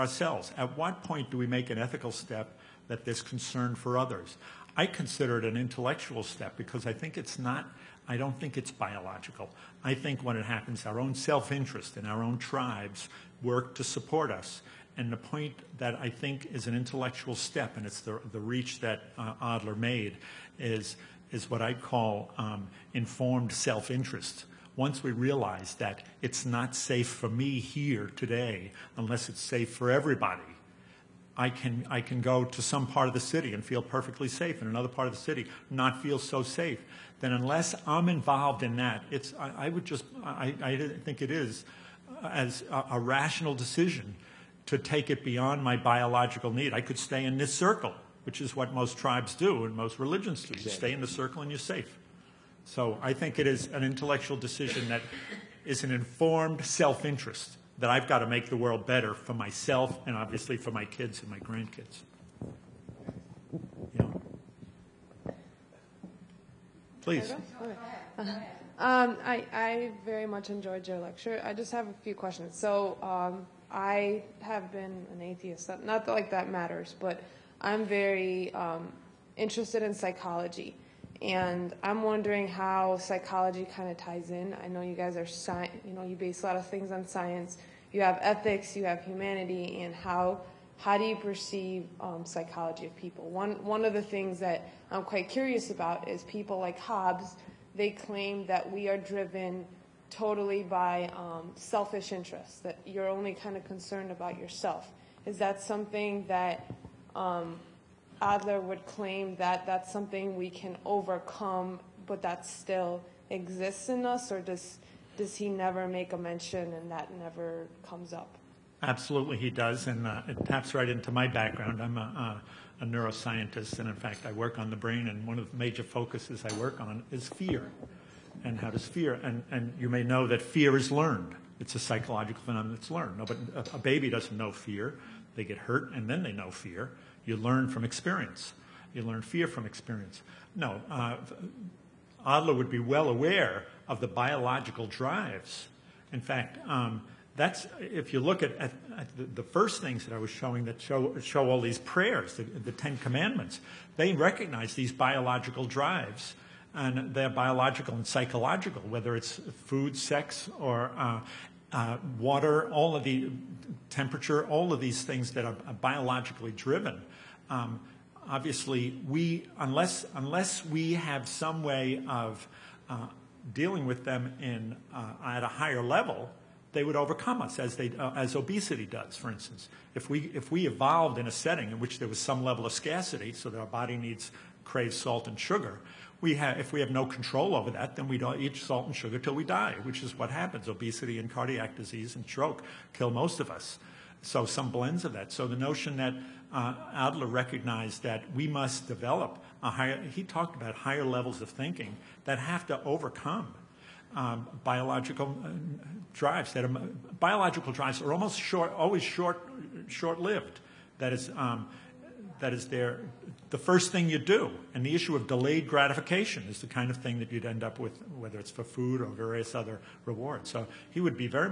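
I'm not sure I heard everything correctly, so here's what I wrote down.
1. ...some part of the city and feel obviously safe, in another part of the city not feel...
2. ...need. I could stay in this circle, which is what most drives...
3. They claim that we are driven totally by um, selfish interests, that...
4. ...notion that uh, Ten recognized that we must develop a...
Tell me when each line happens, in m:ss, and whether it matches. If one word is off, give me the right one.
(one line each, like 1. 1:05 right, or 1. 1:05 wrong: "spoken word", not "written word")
1. 0:32 wrong: "perfectly", not "obviously"
2. 0:46 wrong: "tribes", not "drives"
3. 1:37 right
4. 3:15 wrong: "Adler", not "Ten".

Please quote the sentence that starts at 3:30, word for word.
That is, um, that is their the first thing you do.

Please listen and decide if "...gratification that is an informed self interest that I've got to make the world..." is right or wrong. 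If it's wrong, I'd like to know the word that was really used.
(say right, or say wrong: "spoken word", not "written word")
wrong: "decision", not "gratification".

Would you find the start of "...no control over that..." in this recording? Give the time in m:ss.
3:06.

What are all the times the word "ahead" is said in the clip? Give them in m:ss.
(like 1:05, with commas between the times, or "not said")
not said.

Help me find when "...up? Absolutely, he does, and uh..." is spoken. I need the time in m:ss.
1:58.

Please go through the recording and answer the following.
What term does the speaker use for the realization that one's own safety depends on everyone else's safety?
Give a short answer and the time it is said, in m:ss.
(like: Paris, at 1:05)
informed self-interest, at 0:22.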